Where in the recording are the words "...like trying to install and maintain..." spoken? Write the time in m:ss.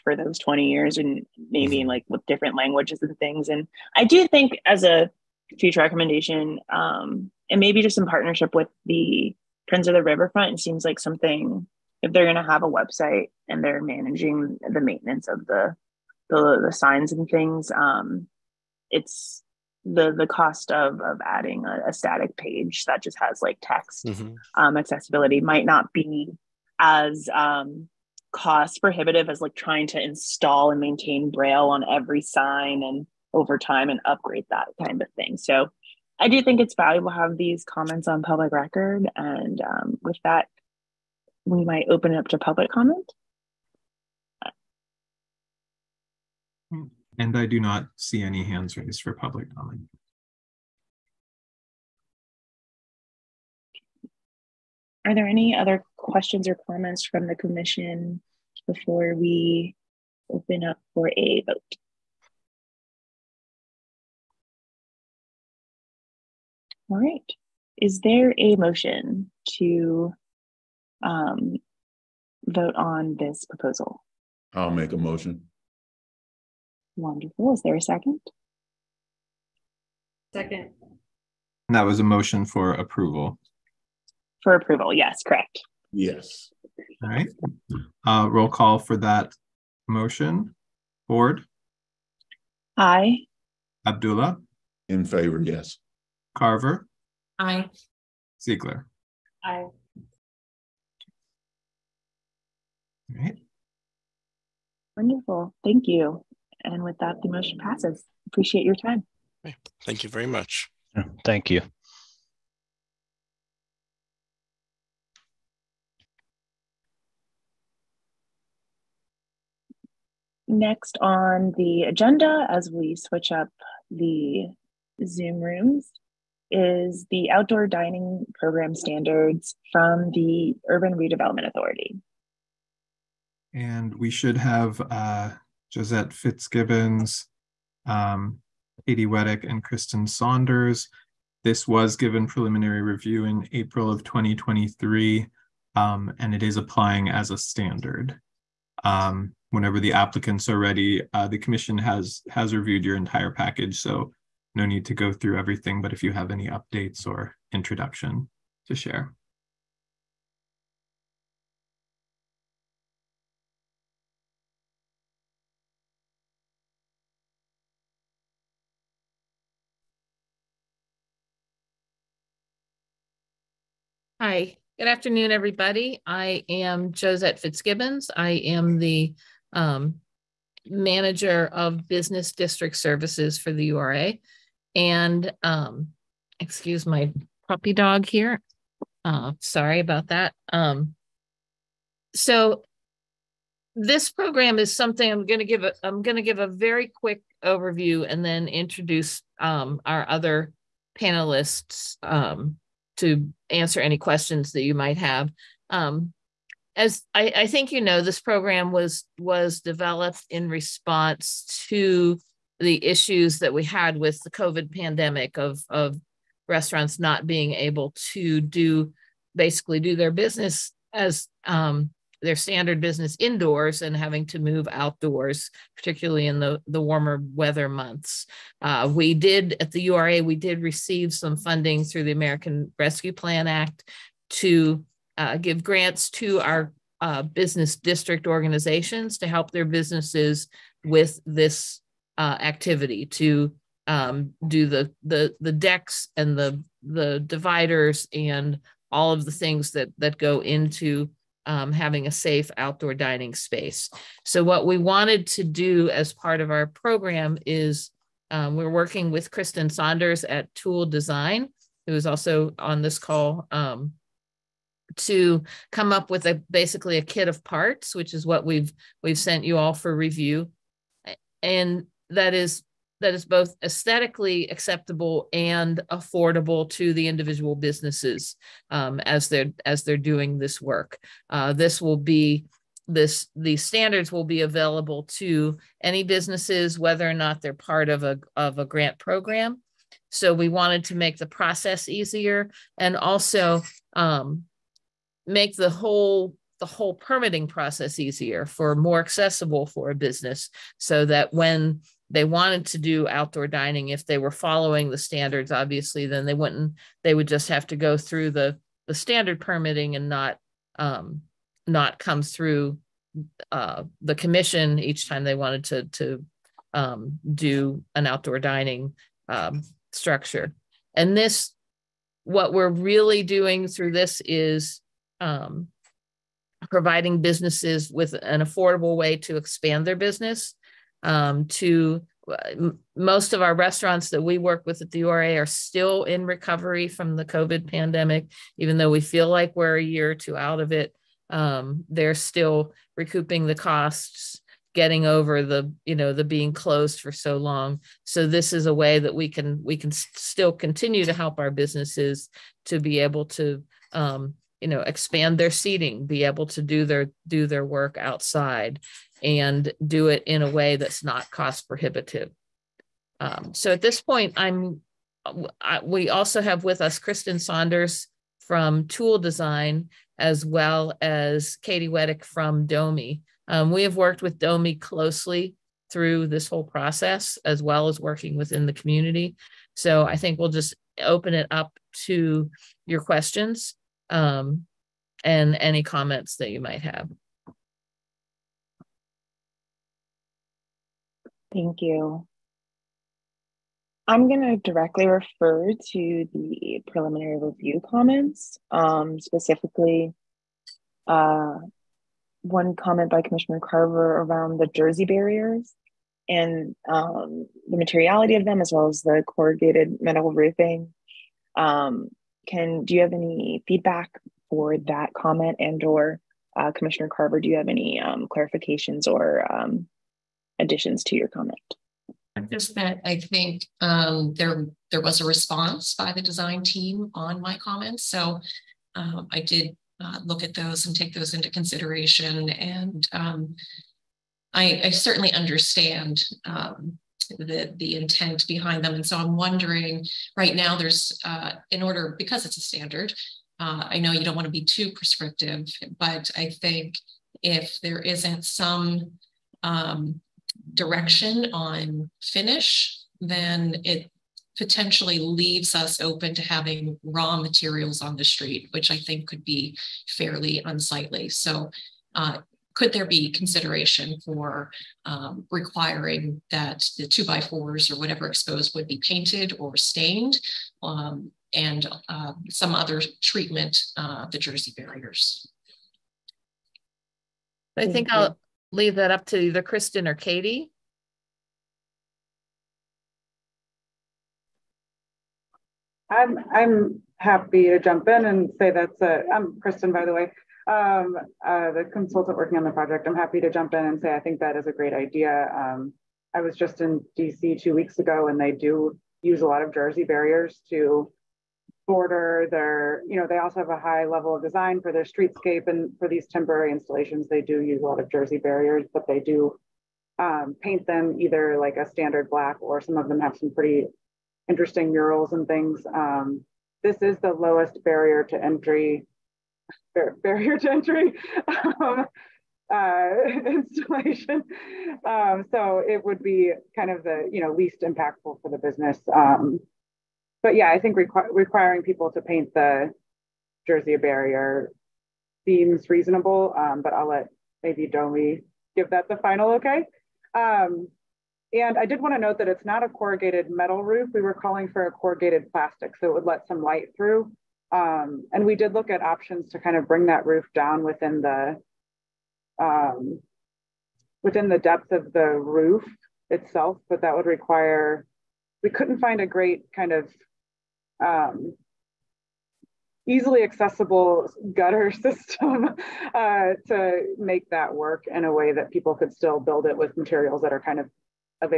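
0:29.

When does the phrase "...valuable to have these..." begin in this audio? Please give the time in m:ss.
0:36.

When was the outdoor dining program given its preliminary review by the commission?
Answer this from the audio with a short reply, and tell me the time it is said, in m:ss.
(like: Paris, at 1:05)
April 2023, at 2:23.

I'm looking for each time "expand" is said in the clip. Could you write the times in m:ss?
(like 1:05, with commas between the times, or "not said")
5:29, 5:54.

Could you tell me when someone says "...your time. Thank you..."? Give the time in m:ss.
1:48.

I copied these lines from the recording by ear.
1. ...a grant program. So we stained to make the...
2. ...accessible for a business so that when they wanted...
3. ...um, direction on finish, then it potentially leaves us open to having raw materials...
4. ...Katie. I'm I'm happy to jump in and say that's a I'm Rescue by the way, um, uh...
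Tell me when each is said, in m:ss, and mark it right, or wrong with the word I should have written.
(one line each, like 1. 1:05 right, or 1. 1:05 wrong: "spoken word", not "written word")
1. 4:48 wrong: "wanted", not "stained"
2. 4:59 right
3. 7:29 right
4. 8:00 wrong: "Kristen", not "Rescue".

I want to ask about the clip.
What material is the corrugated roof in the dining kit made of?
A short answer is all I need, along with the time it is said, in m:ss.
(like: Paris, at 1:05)
Plastic, at 9:05.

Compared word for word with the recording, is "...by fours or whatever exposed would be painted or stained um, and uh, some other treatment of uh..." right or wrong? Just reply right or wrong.
right.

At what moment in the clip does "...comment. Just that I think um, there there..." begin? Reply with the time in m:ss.
7:01.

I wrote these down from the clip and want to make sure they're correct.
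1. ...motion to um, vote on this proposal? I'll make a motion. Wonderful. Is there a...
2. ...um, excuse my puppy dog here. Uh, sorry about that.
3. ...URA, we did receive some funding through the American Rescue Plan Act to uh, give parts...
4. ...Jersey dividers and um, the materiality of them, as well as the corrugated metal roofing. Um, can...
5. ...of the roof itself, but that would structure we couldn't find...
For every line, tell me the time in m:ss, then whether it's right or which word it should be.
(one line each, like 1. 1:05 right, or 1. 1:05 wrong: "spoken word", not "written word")
1. 1:08 right
2. 3:05 right
3. 3:49 wrong: "grants", not "parts"
4. 6:44 wrong: "barriers", not "dividers"
5. 9:14 wrong: "require", not "structure".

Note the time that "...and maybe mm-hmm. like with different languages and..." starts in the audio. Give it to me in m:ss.
0:00.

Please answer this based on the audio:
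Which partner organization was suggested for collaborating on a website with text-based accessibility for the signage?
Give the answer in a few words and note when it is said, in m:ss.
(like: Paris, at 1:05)
Friends of the Riverfront, at 0:09.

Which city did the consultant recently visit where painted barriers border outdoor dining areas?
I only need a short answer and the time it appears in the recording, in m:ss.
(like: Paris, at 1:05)
DC, at 8:17.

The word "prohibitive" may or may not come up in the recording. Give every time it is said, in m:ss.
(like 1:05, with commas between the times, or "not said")
0:28, 6:01.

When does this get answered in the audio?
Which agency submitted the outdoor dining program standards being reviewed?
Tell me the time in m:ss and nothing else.
2:10.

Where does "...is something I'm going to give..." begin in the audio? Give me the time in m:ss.
3:14.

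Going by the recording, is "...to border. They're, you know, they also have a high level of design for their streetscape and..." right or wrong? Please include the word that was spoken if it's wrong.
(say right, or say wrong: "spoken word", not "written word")
right.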